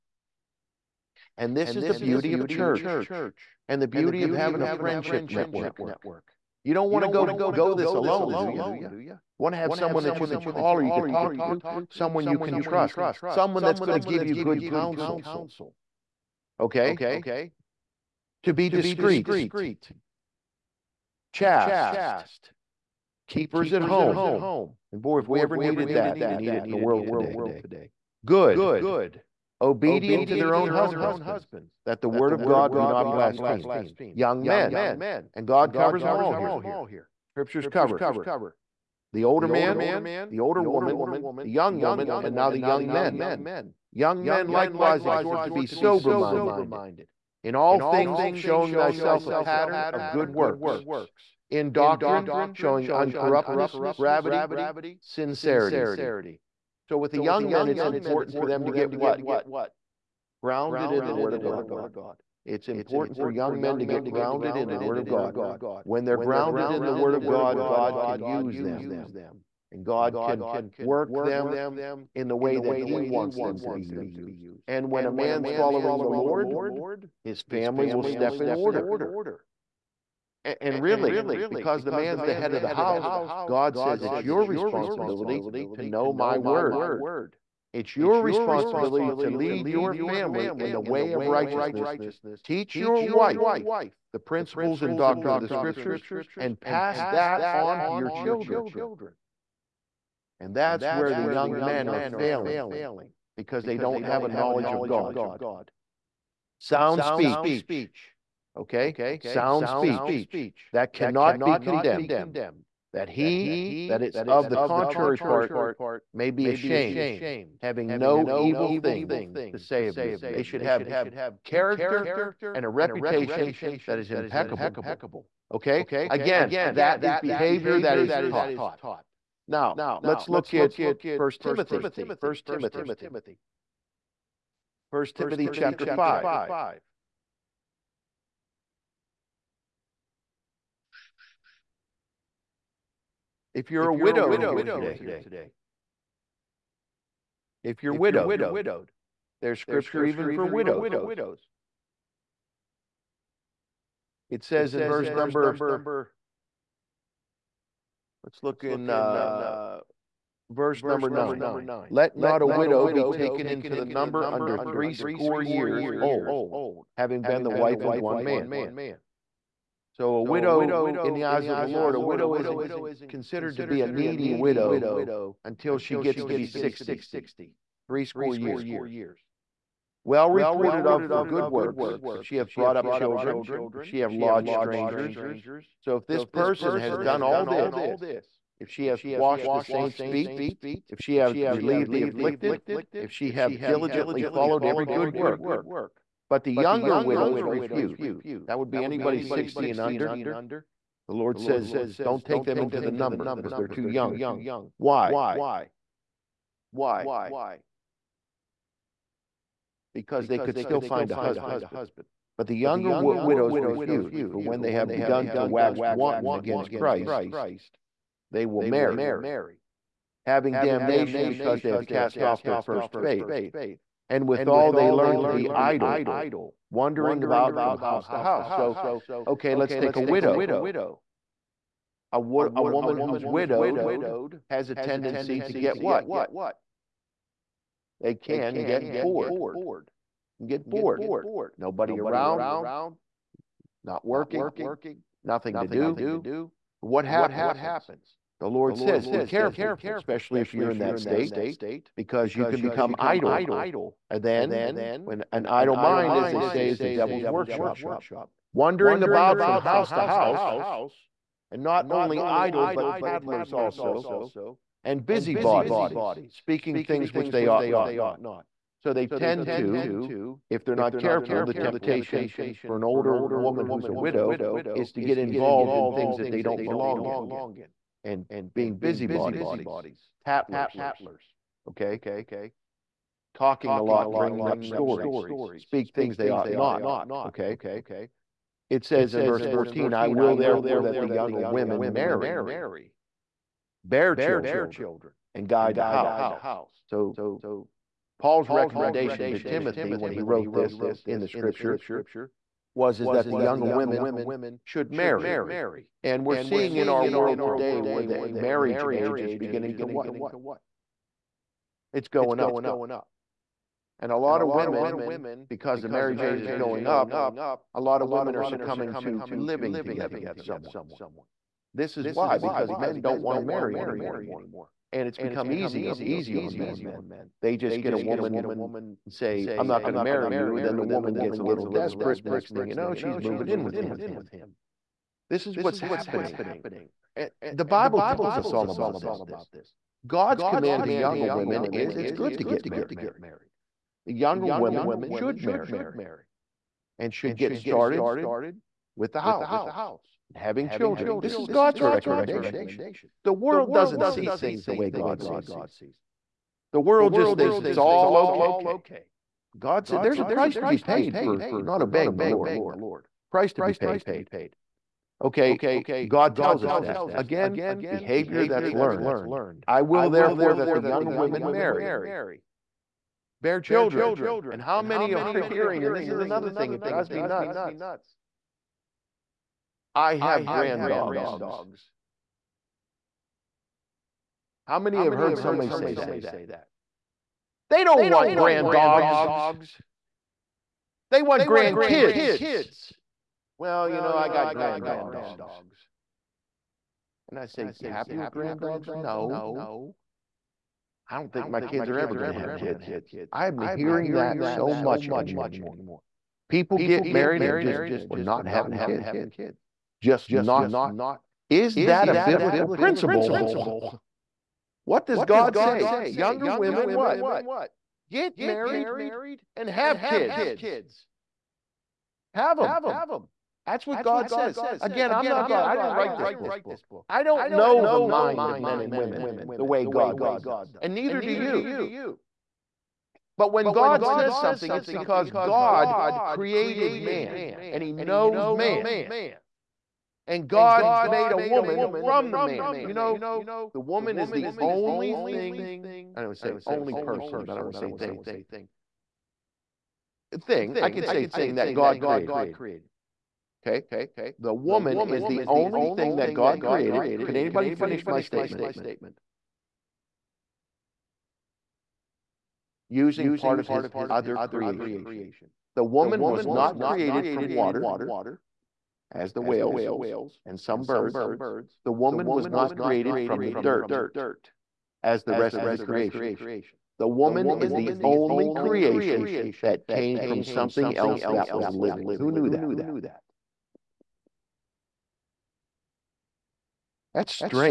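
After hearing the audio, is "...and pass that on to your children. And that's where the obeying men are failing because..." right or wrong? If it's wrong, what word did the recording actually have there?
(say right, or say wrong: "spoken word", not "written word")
wrong: "young", not "obeying".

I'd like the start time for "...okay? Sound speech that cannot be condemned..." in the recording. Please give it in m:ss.
1:48.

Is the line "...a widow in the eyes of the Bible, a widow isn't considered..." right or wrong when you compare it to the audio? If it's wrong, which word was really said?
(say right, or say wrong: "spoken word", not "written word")
wrong: "Lord", not "Bible".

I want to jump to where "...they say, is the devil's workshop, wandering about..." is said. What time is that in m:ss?
4:16.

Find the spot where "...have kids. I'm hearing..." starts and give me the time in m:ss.
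6:42.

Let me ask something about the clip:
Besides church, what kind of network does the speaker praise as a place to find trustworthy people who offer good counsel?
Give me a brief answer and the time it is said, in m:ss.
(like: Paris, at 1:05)
friendship network, at 0:04.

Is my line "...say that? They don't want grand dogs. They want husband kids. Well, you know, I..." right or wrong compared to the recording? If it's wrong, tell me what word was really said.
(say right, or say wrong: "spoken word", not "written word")
wrong: "grand", not "husband".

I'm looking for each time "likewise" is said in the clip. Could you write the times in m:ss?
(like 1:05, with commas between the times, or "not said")
0:44.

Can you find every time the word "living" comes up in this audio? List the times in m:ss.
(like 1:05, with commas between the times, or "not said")
5:19, 8:01.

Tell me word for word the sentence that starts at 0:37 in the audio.
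Scriptures cover the older man, the older woman, the young woman, and now the young men.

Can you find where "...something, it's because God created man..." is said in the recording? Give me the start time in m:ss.
7:14.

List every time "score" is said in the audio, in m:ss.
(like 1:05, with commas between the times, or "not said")
2:44, 2:58.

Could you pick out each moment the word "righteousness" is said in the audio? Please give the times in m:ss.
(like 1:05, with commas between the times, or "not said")
1:31.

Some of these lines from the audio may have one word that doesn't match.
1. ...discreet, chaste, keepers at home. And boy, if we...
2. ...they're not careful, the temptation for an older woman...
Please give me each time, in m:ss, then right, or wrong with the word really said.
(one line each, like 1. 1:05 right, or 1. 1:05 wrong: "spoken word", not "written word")
1. 0:18 right
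2. 4:30 right.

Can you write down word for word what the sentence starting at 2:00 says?
They should have character and a reputation that is impeccable.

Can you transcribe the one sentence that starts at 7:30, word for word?
Thing, I could say thing that God created.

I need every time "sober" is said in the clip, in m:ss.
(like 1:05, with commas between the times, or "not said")
0:45.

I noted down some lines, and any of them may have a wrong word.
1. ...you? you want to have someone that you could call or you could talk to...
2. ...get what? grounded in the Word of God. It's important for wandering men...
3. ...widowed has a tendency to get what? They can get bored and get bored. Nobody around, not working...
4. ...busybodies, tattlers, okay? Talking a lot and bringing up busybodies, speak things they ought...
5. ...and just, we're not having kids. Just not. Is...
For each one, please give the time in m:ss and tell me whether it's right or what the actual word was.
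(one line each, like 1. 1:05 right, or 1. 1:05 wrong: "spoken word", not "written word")
1. 0:08 right
2. 0:58 wrong: "young", not "wandering"
3. 3:53 right
4. 4:38 wrong: "stories", not "busybodies"
5. 6:47 right.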